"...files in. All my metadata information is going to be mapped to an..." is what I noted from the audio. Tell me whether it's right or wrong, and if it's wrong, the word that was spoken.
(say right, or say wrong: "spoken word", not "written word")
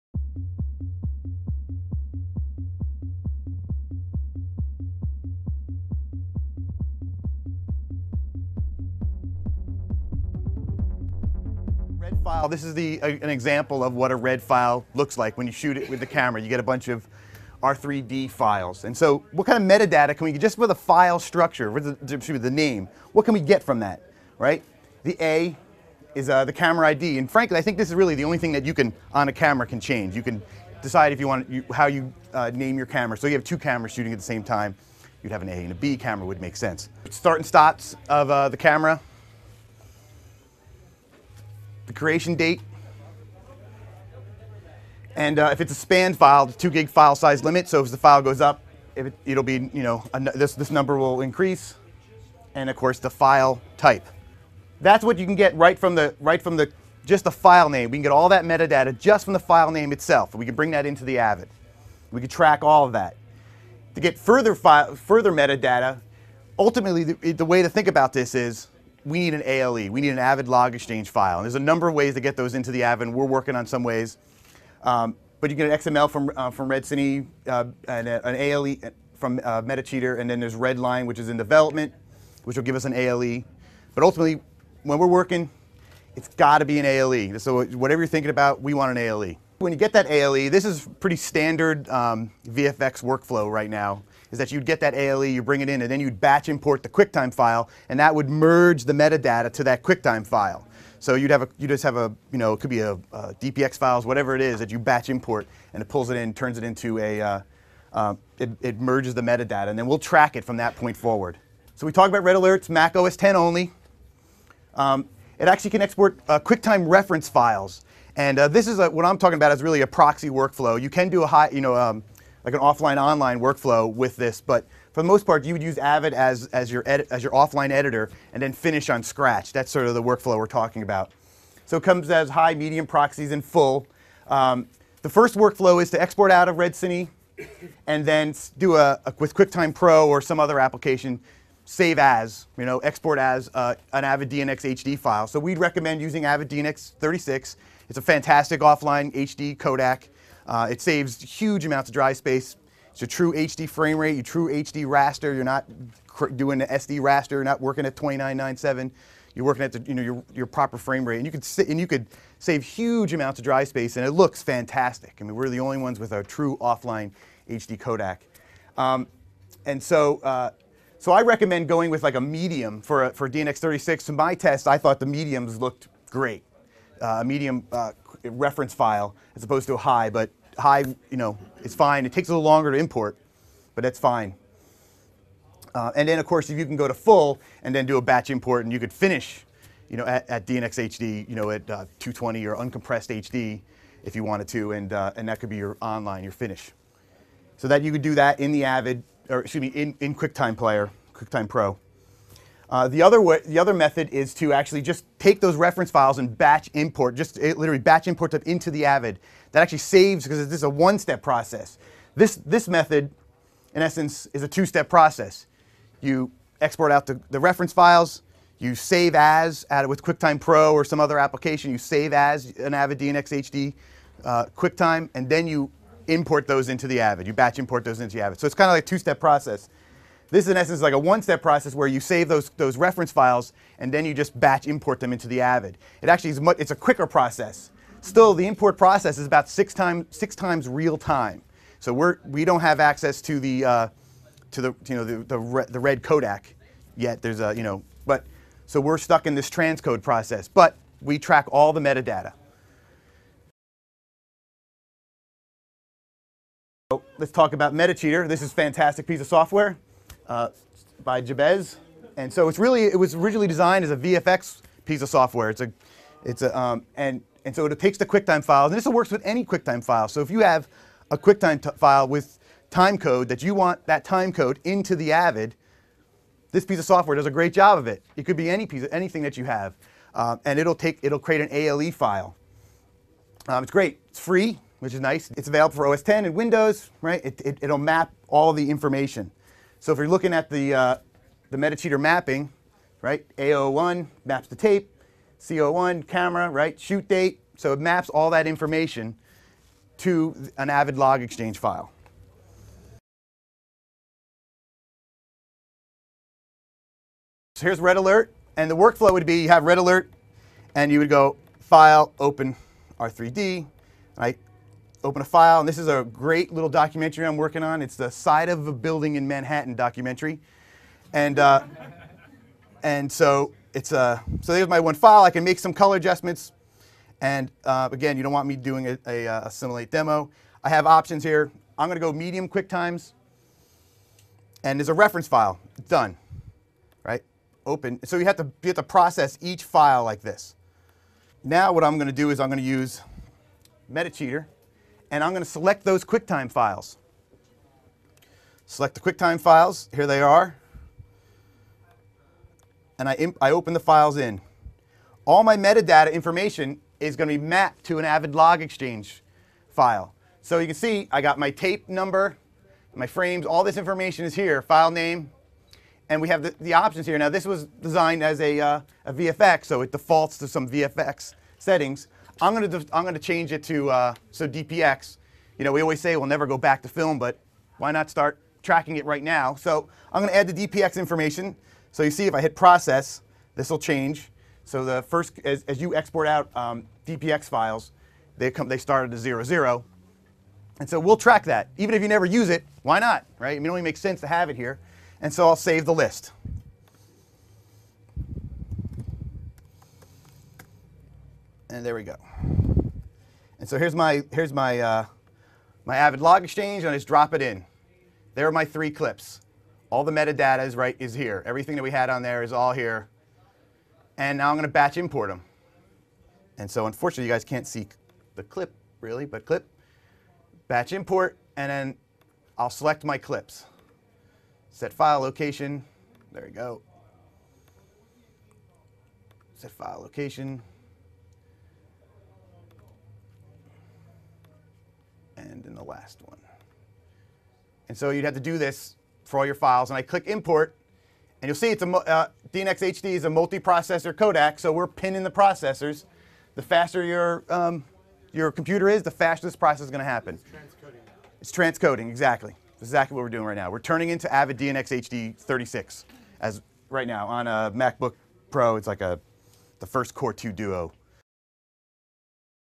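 right.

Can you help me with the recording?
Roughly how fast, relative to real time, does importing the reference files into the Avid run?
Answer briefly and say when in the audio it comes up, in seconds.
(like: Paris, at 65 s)
6 times real time, at 240 s.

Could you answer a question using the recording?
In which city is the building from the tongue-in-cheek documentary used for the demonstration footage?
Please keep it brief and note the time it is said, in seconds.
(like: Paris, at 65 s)
Manhattan, at 319 s.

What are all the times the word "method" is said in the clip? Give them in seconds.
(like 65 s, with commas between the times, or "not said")
203 s, 212 s.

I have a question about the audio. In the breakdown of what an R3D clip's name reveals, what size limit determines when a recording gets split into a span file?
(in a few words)
2 gig.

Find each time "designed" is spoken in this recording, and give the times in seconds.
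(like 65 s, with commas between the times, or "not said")
263 s, 367 s.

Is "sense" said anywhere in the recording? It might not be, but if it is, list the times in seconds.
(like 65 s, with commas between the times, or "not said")
36 s, 393 s.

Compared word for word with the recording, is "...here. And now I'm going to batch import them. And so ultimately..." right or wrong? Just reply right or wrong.
wrong.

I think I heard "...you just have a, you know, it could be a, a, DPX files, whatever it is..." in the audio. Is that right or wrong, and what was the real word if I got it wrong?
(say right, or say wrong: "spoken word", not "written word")
right.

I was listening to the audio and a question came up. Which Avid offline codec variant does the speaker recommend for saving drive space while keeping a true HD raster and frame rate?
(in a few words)
Avid DNX 36.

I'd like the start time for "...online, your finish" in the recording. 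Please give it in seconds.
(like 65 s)
195 s.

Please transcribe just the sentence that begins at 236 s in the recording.
It actually is much, it's a quicker process.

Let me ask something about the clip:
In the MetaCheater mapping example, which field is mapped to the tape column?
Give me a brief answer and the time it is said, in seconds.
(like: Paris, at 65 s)
A01, at 293 s.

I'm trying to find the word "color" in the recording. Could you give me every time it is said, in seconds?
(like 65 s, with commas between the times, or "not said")
325 s.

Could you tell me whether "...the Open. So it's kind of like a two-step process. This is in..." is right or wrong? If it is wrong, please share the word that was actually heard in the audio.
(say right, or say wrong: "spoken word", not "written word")
wrong: "Avid", not "Open".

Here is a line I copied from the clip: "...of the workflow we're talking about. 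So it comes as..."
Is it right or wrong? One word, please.
right.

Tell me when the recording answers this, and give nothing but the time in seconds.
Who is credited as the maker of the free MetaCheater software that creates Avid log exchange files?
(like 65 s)
261 s.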